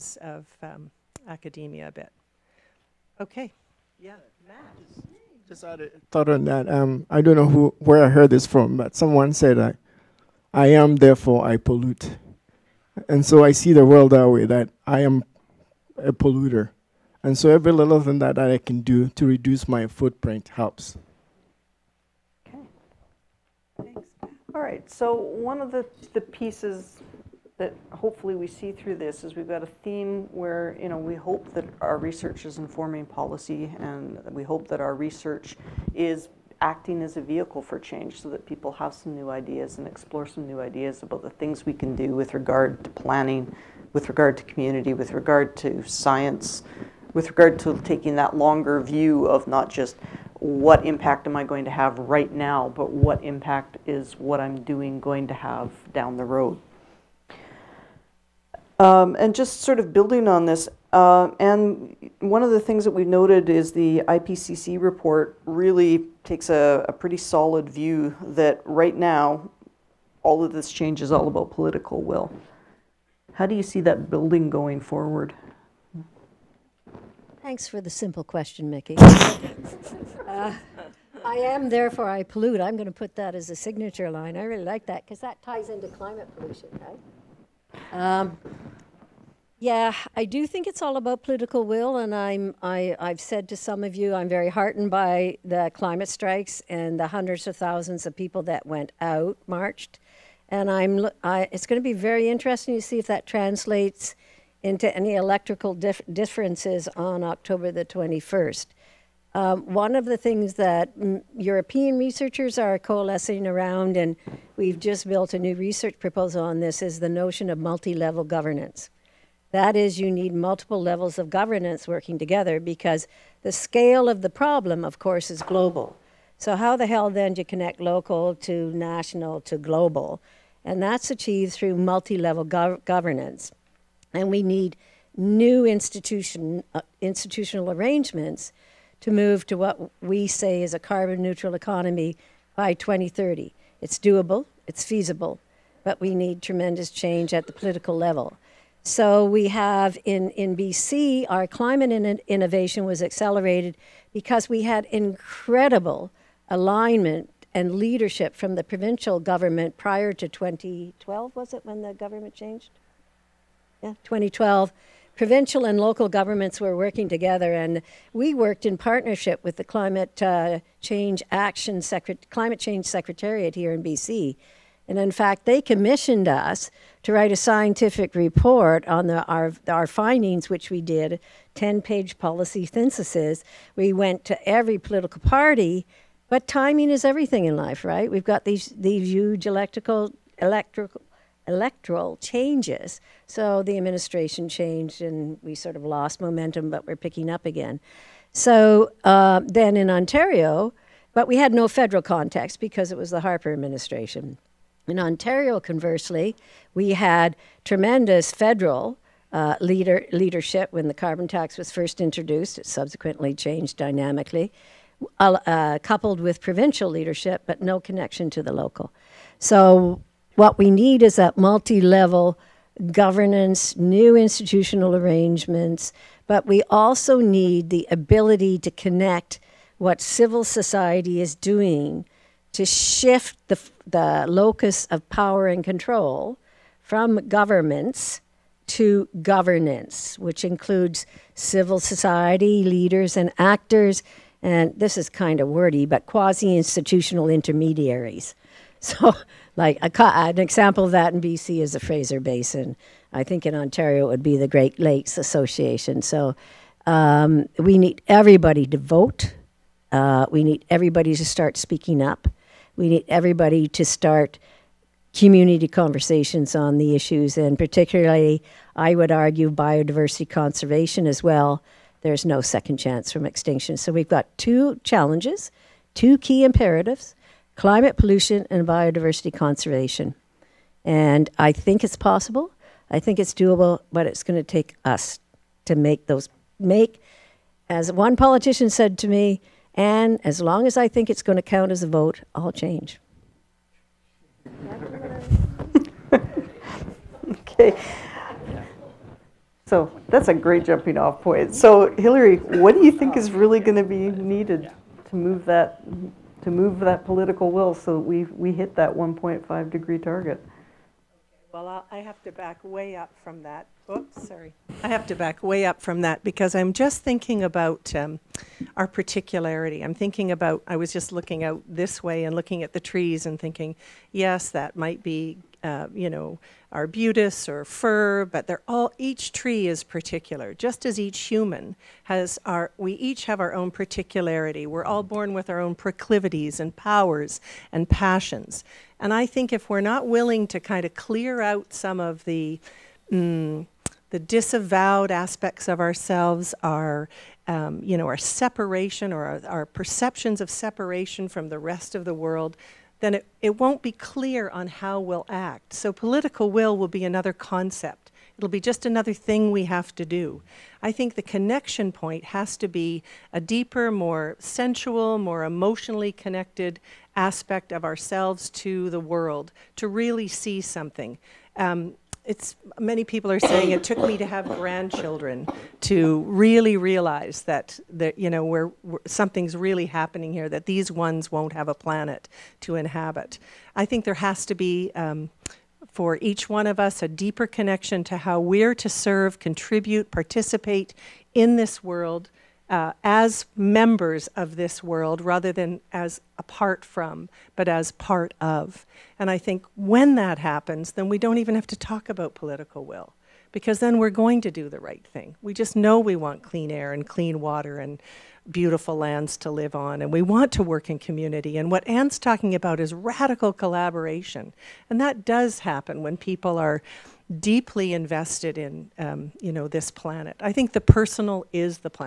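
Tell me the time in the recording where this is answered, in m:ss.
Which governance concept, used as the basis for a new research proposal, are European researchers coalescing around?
1:57.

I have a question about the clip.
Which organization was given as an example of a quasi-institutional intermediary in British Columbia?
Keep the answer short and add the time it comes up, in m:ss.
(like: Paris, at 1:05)
Fraser Basin, at 4:11.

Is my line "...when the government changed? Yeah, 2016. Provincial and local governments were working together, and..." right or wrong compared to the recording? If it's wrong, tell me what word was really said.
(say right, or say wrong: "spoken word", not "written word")
wrong: "2012", not "2016".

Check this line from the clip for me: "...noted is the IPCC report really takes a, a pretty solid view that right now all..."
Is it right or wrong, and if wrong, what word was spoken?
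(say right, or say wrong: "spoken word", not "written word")
right.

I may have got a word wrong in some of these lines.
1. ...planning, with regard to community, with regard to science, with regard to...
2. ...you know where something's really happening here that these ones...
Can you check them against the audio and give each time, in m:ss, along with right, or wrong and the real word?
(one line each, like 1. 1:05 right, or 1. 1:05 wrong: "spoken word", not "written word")
1. 0:42 right
2. 6:18 right.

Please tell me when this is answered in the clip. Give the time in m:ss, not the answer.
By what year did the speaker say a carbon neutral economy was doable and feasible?
2:22.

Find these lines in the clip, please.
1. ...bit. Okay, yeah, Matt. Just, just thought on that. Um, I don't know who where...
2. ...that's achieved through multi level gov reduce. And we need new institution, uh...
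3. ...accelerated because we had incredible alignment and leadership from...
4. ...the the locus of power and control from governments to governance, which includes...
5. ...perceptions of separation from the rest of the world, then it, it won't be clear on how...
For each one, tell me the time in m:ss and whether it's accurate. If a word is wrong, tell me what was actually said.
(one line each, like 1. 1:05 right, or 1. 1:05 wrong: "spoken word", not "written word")
1. 0:01 right
2. 2:10 wrong: "governance", not "reduce"
3. 2:33 right
4. 3:53 right
5. 5:49 right.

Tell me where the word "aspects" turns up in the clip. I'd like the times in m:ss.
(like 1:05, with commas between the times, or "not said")
5:45, 6:07.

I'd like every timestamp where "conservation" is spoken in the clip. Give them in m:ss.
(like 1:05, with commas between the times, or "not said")
4:30, 4:39.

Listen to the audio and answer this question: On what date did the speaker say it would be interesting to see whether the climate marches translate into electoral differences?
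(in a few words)
October 21.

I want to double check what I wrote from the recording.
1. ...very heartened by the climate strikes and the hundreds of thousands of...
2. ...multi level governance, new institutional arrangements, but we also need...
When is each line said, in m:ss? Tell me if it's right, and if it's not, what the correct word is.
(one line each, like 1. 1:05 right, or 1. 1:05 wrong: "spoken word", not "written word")
1. 1:34 right
2. 3:41 right.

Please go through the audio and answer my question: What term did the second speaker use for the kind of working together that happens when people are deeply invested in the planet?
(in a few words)
radical collaboration.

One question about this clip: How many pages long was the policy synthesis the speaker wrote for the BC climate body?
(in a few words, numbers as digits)
10.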